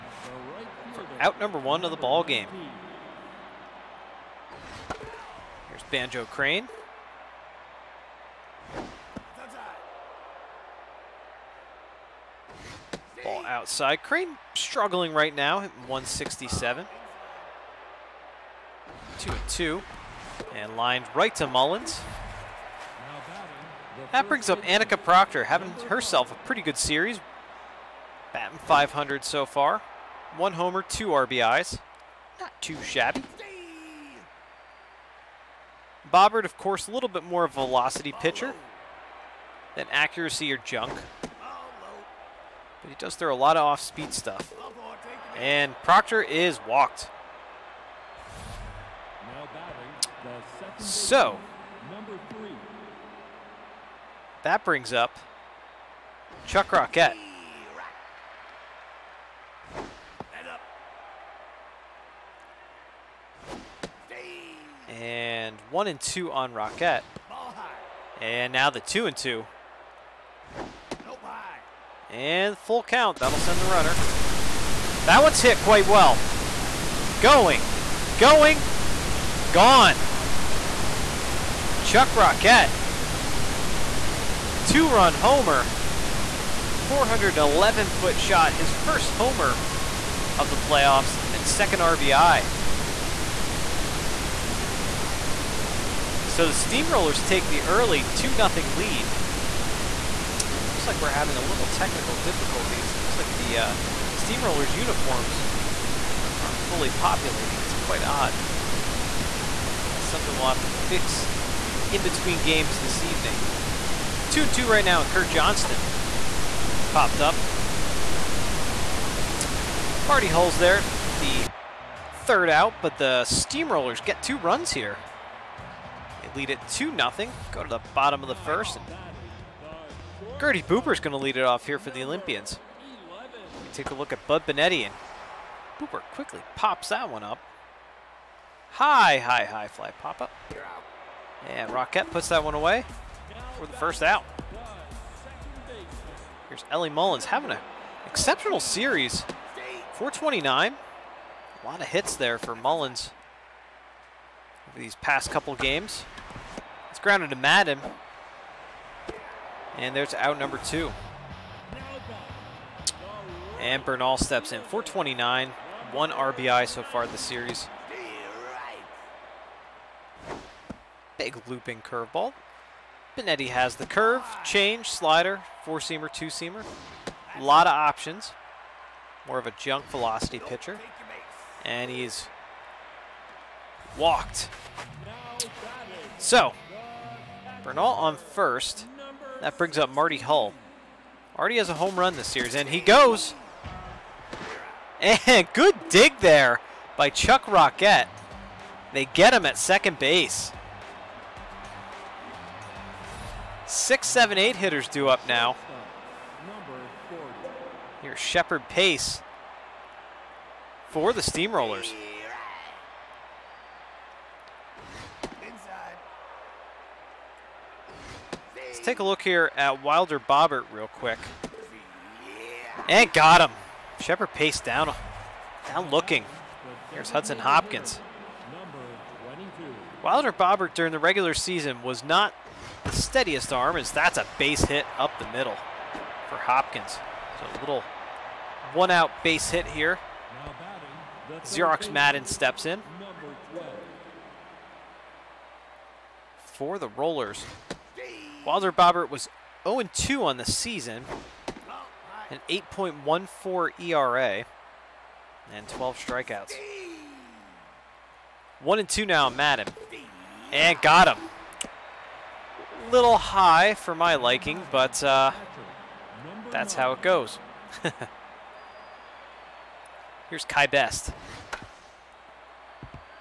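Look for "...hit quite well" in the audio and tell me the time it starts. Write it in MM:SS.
01:15.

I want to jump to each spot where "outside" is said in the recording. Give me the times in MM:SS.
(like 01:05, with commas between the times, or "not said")
00:13.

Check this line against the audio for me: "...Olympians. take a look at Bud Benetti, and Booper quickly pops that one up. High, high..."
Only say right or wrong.
right.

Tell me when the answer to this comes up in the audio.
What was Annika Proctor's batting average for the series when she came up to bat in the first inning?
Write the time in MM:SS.
00:28.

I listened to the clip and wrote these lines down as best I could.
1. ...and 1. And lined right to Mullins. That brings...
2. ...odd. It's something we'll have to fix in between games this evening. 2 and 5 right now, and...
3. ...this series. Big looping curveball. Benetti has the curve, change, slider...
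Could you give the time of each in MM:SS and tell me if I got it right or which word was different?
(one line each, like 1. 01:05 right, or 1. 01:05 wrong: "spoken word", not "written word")
1. 00:19 wrong: "2", not "1"
2. 01:48 wrong: "2", not "5"
3. 02:47 right.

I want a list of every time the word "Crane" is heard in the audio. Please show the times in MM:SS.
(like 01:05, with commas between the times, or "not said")
00:06, 00:14.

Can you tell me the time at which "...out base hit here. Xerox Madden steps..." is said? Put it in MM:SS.
03:58.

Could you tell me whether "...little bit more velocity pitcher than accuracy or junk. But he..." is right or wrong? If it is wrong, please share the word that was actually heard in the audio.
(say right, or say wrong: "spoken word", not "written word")
right.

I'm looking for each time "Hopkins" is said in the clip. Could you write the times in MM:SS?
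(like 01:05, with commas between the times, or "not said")
03:47, 03:56.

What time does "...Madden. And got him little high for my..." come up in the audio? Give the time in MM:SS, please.
04:19.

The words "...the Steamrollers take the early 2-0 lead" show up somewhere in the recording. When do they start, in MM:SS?
01:36.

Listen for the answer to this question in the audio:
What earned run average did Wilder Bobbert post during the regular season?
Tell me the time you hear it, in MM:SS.
04:12.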